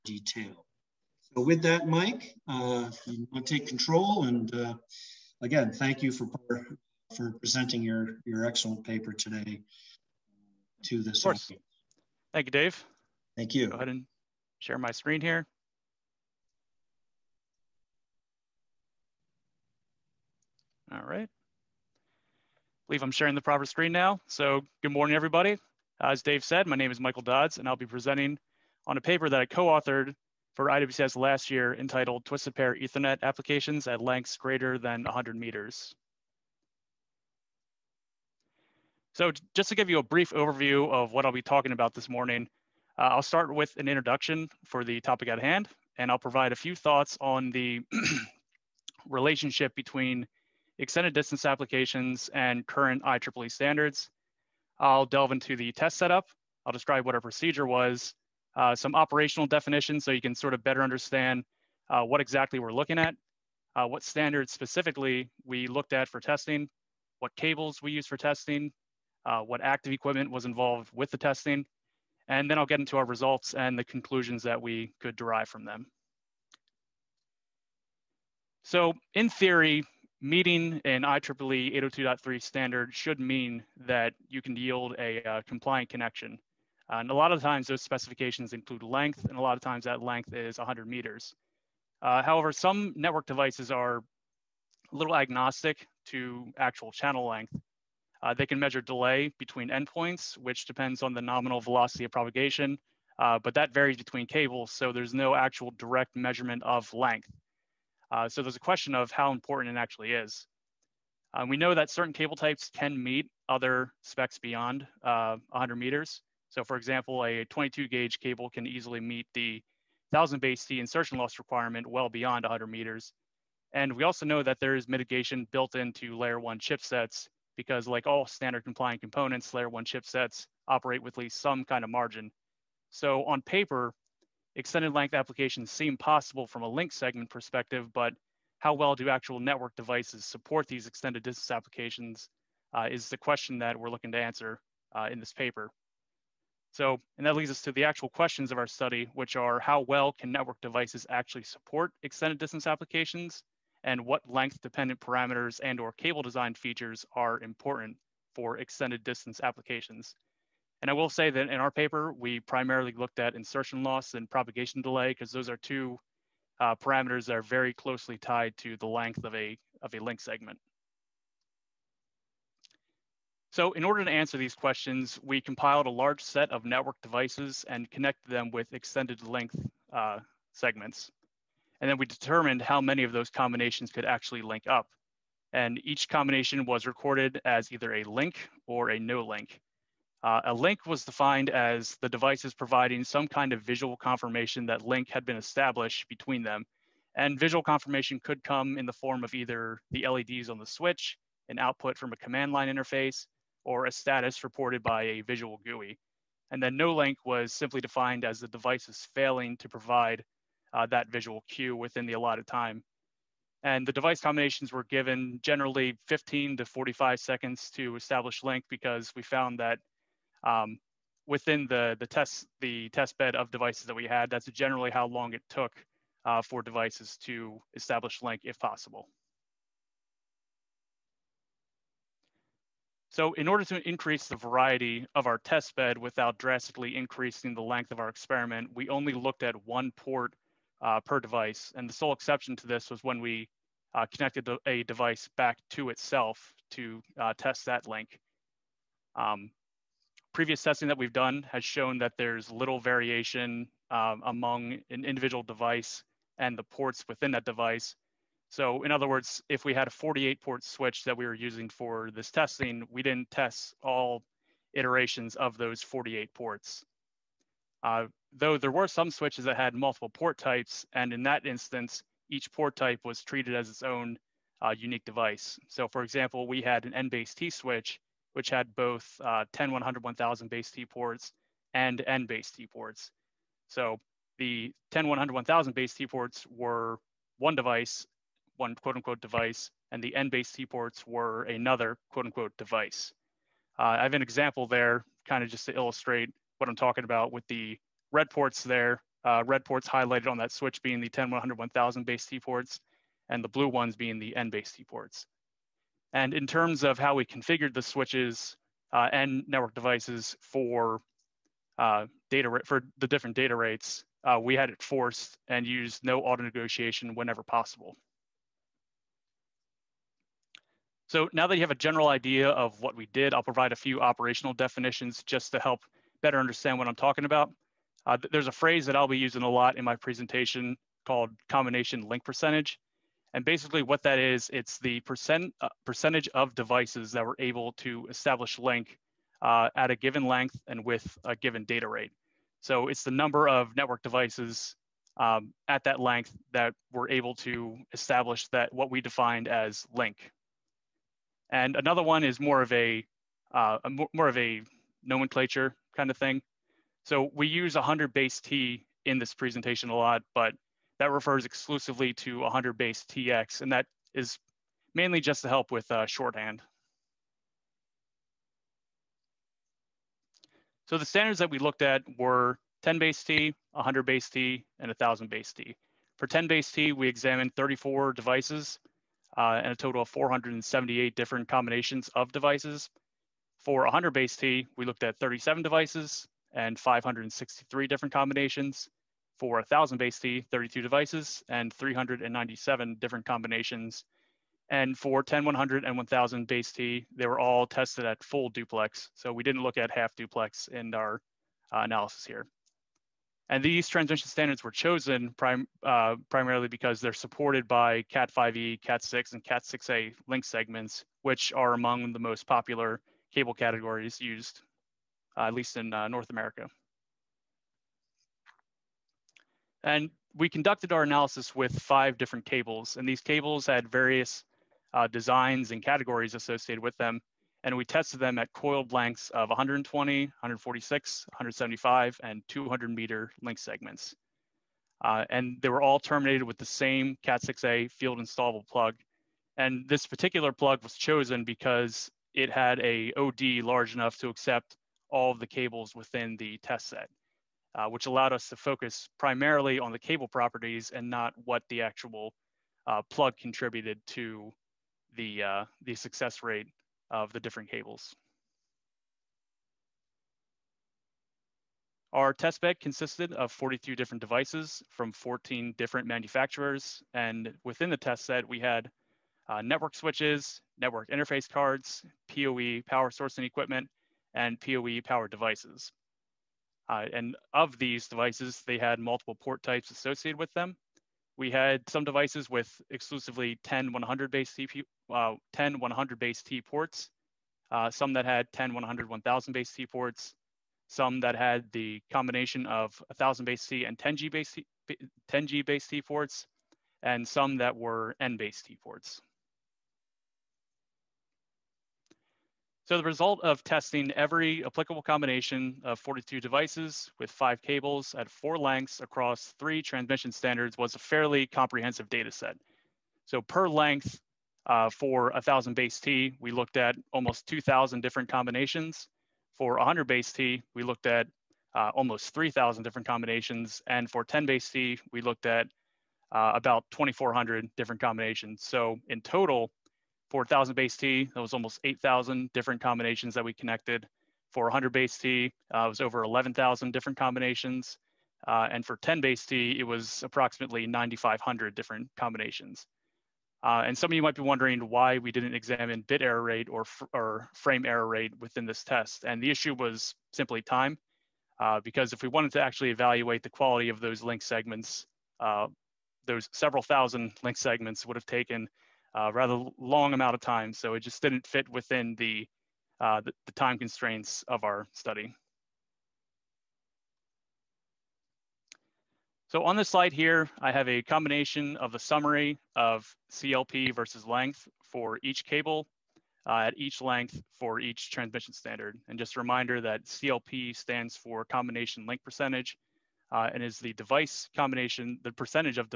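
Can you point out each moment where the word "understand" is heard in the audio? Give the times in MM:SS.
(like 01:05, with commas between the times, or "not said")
01:00, 05:26.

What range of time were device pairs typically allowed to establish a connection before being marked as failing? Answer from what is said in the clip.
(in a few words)
15 to 45 seconds.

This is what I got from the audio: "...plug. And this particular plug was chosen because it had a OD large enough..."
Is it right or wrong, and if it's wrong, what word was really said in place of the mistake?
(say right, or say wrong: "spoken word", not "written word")
right.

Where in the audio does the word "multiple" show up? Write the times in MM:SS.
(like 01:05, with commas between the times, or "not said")
04:29, 07:58.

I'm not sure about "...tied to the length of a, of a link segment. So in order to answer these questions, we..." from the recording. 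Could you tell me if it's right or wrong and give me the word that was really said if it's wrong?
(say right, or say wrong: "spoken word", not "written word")
right.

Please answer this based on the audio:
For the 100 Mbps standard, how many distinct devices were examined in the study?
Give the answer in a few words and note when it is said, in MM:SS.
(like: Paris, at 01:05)
37, at 06:25.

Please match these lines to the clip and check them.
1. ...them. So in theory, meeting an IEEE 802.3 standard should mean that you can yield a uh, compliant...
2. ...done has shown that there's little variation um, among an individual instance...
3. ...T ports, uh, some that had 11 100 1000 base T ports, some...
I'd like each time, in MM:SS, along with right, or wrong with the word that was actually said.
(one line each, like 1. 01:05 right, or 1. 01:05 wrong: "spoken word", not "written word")
1. 01:15 right
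2. 04:11 wrong: "device", not "instance"
3. 08:06 wrong: "10", not "11".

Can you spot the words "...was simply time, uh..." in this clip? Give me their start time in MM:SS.
09:09.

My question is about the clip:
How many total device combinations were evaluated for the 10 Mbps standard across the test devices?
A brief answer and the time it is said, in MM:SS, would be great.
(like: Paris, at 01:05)
478, at 06:20.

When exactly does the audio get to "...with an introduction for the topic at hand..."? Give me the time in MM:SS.
00:43.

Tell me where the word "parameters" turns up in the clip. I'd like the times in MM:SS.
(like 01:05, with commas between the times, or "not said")
02:34, 02:46.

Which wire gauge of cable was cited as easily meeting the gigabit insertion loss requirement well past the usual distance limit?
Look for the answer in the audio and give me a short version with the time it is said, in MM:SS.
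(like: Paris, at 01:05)
22 gauge, at 01:57.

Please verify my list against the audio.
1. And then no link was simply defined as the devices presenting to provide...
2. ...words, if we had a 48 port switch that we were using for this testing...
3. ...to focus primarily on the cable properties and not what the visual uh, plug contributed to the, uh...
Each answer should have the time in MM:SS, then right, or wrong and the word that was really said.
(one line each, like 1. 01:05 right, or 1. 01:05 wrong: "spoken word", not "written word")
1. 03:26 wrong: "failing", not "presenting"
2. 04:19 right
3. 07:28 wrong: "actual", not "visual".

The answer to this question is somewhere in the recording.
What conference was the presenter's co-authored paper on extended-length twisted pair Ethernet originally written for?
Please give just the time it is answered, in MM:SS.
00:30.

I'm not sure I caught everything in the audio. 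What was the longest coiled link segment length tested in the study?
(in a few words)
200 meters.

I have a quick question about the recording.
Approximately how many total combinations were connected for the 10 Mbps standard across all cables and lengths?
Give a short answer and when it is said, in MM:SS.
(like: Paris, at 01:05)
9,500, at 09:00.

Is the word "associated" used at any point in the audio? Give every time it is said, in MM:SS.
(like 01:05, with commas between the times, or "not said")
07:06, 07:59.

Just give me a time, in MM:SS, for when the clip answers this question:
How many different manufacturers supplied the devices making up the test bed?
07:45.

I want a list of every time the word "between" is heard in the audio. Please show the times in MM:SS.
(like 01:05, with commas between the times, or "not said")
00:49, 01:39, 01:43, 03:16.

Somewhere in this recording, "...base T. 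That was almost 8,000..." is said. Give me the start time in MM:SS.
08:50.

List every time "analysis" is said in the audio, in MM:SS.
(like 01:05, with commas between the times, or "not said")
06:41, 07:01.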